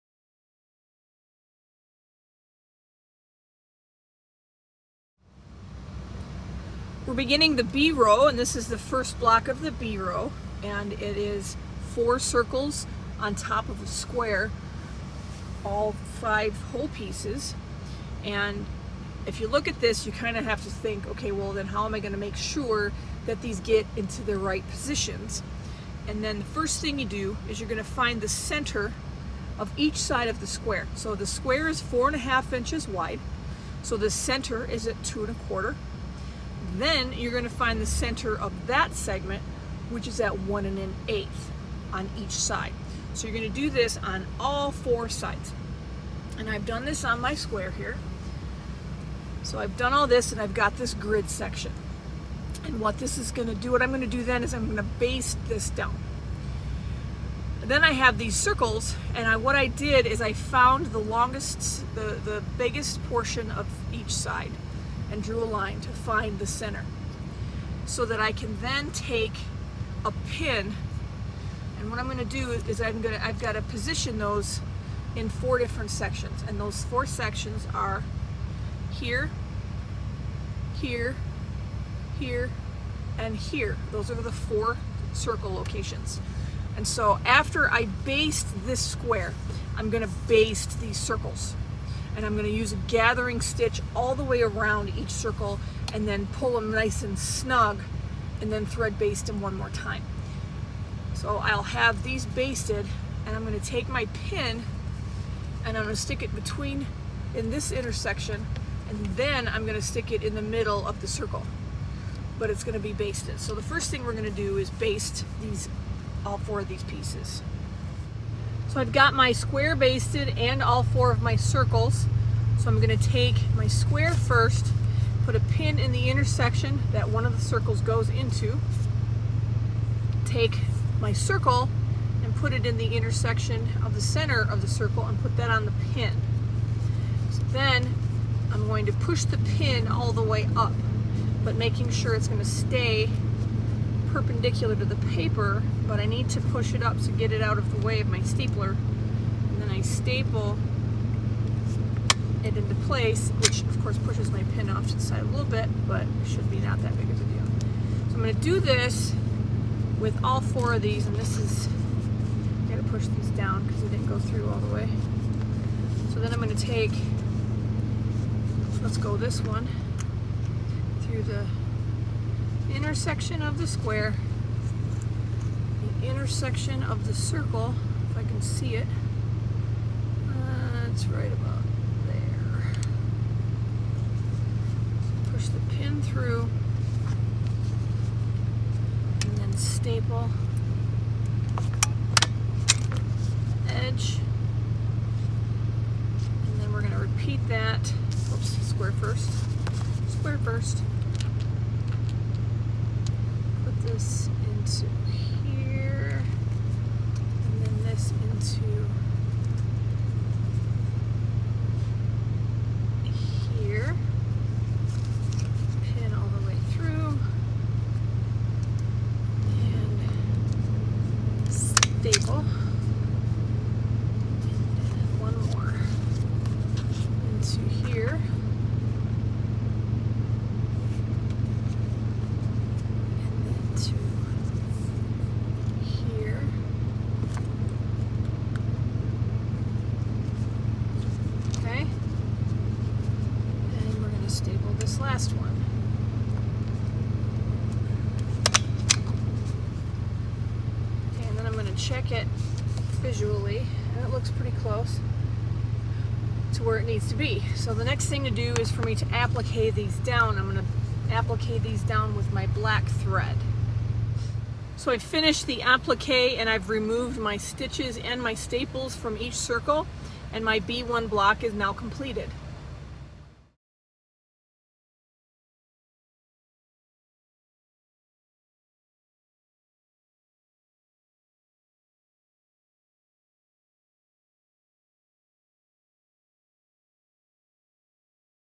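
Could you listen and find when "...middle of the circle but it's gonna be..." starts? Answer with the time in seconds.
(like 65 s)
110 s.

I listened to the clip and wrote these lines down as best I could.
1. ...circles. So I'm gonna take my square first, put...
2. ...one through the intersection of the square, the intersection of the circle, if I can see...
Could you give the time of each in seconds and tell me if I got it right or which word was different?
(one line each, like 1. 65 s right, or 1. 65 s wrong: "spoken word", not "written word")
1. 121 s right
2. 169 s right.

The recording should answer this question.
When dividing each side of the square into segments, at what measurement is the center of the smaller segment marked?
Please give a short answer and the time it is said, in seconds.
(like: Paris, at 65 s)
1 1/8, at 40 s.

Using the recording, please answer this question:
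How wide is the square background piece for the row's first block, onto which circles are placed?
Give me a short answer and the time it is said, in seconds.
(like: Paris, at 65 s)
4 1/2 inches, at 31 s.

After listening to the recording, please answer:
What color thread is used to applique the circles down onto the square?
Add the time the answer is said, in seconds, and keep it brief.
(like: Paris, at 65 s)
Black, at 262 s.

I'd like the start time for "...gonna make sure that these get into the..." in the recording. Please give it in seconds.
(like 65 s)
21 s.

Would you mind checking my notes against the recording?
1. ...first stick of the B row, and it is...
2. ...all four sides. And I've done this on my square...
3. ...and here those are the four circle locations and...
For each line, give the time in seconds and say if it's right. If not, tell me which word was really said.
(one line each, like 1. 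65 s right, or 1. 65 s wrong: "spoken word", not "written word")
1. 8 s wrong: "block", not "stick"
2. 44 s right
3. 83 s right.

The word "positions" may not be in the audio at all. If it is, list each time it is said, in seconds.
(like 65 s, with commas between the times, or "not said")
24 s, 73 s.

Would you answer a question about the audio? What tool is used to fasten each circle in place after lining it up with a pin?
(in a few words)
Stapler.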